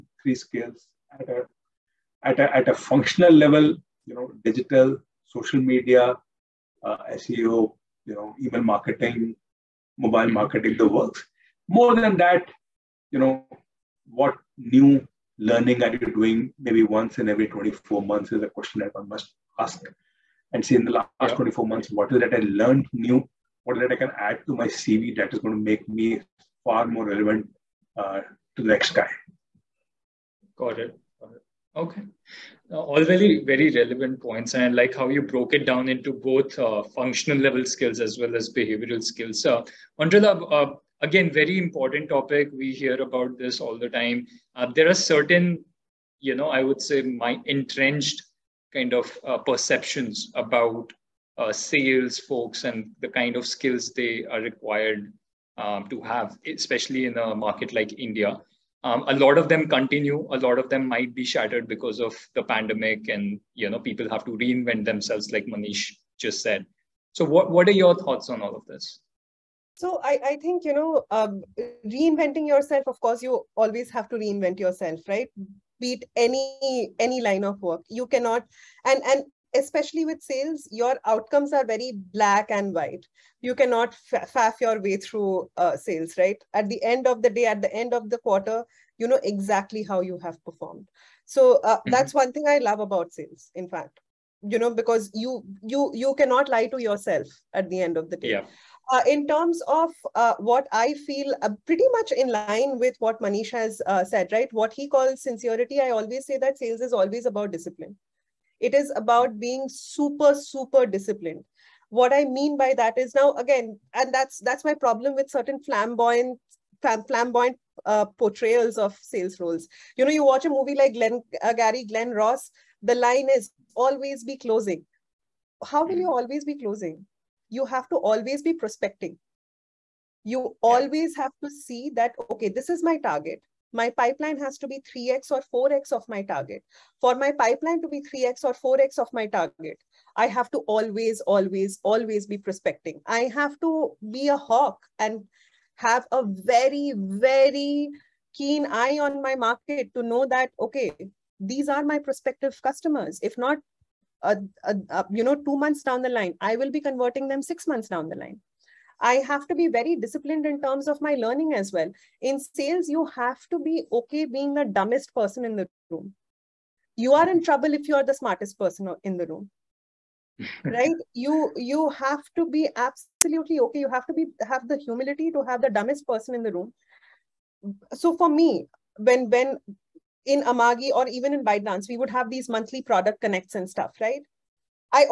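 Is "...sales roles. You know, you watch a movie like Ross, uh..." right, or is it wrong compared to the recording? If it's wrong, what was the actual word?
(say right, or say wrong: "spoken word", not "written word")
wrong: "Glenn", not "Ross".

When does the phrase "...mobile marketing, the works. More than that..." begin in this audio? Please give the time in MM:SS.
00:09.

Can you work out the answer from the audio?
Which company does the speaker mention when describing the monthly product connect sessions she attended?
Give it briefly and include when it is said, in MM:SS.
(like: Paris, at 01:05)
Amagi, at 03:00.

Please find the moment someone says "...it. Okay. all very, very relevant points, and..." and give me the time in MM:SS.
00:30.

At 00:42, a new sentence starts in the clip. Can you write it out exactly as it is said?
We hear about this all the time.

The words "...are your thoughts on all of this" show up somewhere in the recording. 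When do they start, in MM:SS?
01:07.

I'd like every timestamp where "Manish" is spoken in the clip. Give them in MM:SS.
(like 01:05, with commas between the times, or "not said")
01:05, 01:43.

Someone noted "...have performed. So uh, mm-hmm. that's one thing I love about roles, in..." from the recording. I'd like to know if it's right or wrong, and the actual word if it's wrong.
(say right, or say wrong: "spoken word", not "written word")
wrong: "sales", not "roles".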